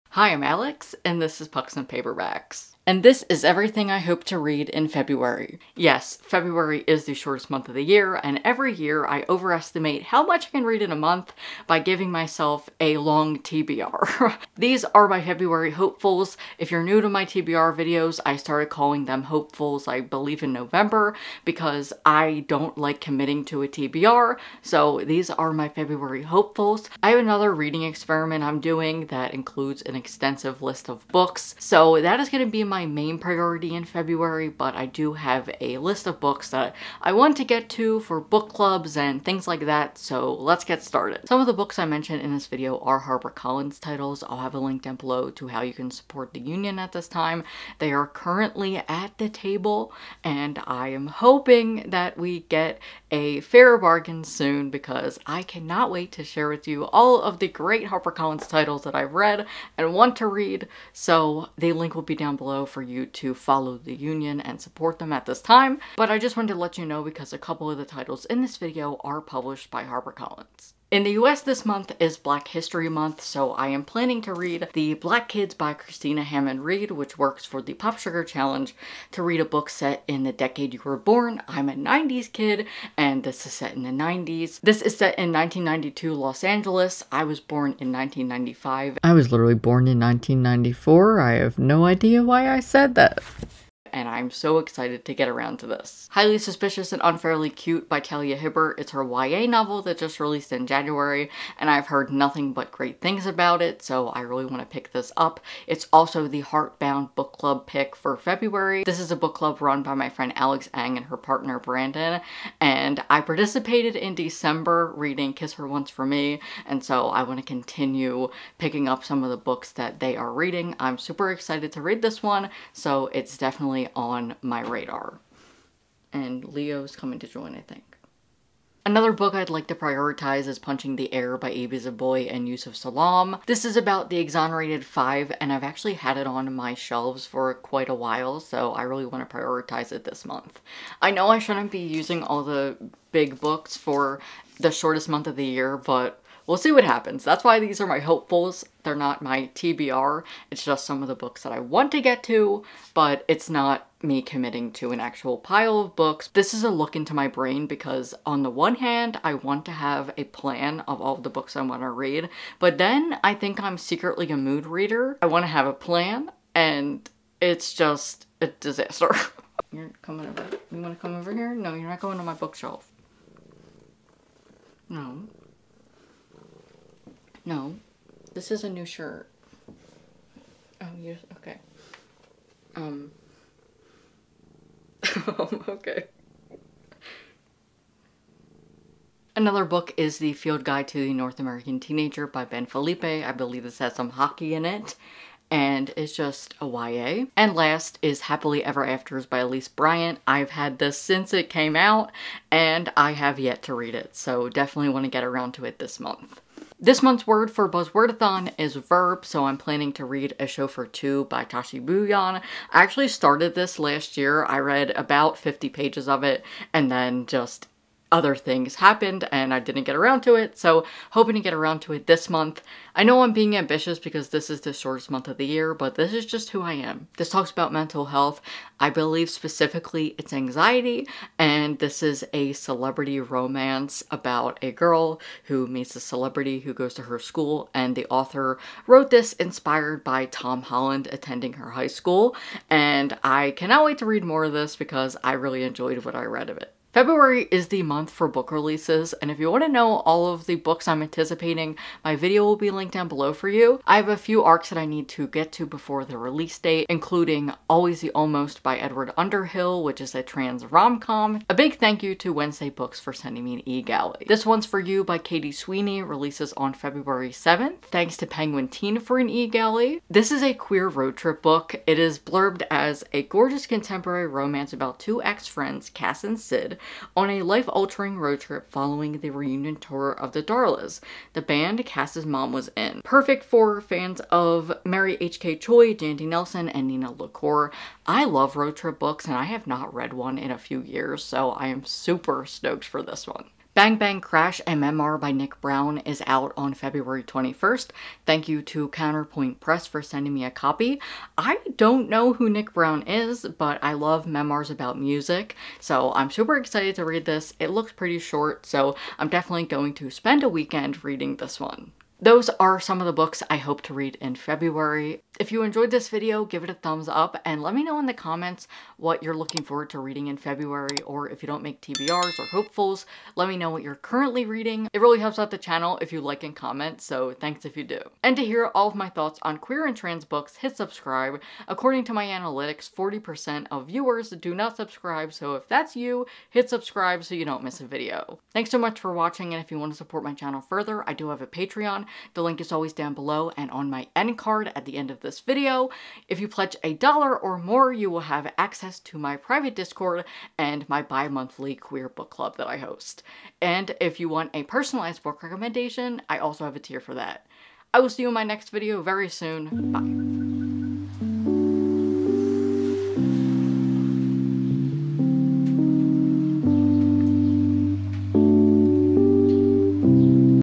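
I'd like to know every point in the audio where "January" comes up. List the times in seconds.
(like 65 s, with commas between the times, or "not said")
100 s.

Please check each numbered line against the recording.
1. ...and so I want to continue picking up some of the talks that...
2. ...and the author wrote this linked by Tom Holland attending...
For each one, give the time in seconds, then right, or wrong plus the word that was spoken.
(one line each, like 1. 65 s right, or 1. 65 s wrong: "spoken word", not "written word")
1. 116 s wrong: "books", not "talks"
2. 237 s wrong: "inspired", not "linked".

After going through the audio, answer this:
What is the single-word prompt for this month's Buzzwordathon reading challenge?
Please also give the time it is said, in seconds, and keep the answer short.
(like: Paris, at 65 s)
verb, at 208 s.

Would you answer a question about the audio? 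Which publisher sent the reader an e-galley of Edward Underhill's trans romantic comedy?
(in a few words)
Wednesday Books.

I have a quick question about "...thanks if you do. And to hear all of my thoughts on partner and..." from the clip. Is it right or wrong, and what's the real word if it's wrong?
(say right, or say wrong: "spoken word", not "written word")
wrong: "queer", not "partner".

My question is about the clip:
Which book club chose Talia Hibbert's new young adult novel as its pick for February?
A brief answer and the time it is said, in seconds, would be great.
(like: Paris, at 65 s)
Heartbound Book Club, at 106 s.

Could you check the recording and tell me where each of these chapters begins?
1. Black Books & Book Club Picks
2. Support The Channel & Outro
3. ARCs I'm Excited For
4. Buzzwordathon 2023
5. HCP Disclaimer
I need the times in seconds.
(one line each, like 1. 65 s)
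1. 73 s
2. 313 s
3. 250 s
4. 206 s
5. 40 s.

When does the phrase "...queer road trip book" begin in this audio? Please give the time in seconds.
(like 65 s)
270 s.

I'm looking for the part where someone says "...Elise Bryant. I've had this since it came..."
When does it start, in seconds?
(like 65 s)
199 s.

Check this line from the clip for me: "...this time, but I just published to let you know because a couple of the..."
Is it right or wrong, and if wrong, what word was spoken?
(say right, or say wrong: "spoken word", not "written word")
wrong: "wanted", not "published".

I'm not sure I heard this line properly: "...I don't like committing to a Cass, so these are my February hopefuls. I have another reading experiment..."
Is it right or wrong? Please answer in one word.
wrong.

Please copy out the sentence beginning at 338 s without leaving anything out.
Thanks so much for watching, and if you want to support my channel further, I do have a Patreon.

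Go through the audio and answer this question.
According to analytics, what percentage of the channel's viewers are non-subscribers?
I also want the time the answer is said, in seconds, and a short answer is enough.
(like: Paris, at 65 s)
40%, at 332 s.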